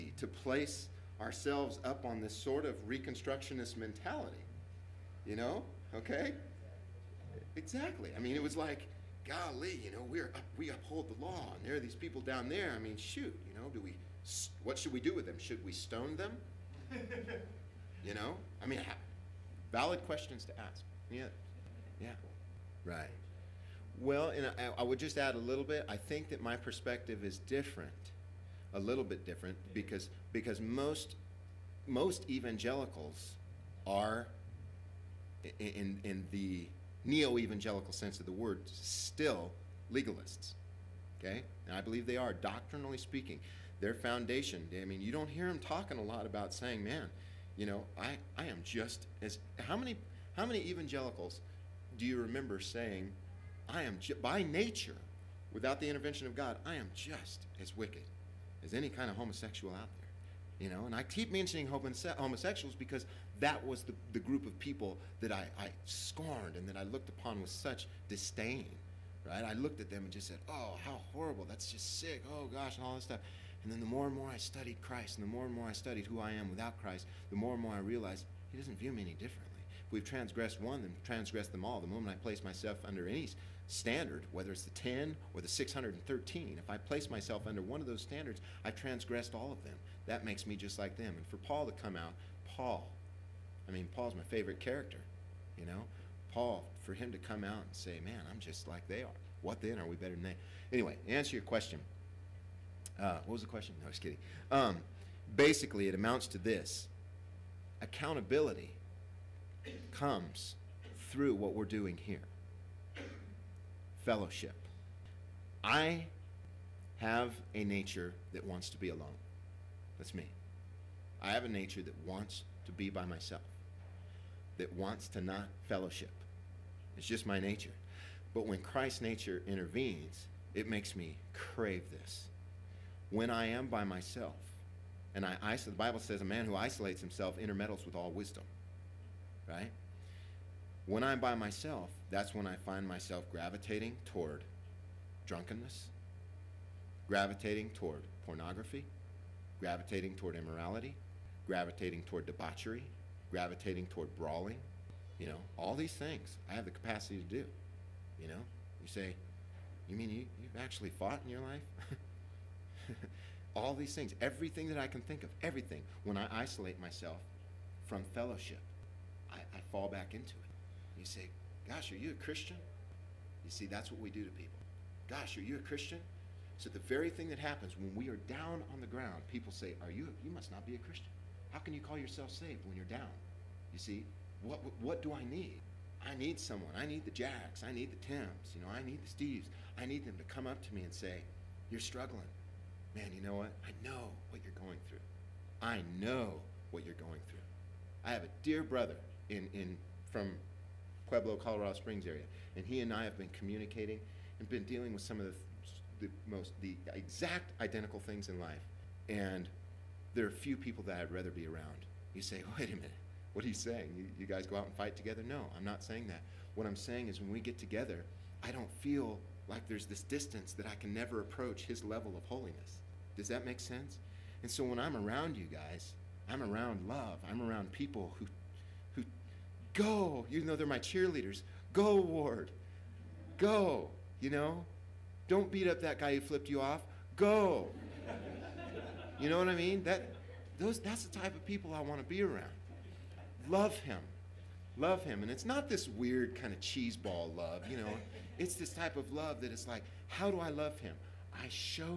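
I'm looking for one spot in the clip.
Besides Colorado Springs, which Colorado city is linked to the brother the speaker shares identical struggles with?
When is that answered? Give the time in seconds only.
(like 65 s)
201 s.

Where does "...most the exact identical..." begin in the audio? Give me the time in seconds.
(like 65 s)
206 s.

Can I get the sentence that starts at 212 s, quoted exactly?
You say, wait a minute, what are you saying?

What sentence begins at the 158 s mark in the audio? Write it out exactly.
You say, you mean you, you've actually fought in your life?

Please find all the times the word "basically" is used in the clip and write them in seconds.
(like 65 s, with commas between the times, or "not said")
105 s.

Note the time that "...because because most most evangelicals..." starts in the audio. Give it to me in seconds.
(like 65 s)
29 s.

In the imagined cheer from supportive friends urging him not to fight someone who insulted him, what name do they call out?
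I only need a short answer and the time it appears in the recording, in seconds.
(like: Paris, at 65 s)
Ward, at 232 s.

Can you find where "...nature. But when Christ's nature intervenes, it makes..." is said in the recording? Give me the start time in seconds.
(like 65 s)
127 s.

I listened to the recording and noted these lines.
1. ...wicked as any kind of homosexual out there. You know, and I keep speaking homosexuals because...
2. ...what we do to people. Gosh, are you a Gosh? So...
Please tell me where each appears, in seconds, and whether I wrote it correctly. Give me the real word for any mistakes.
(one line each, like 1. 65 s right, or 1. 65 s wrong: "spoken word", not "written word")
1. 57 s wrong: "mentioning", not "speaking"
2. 173 s wrong: "Christian", not "Gosh".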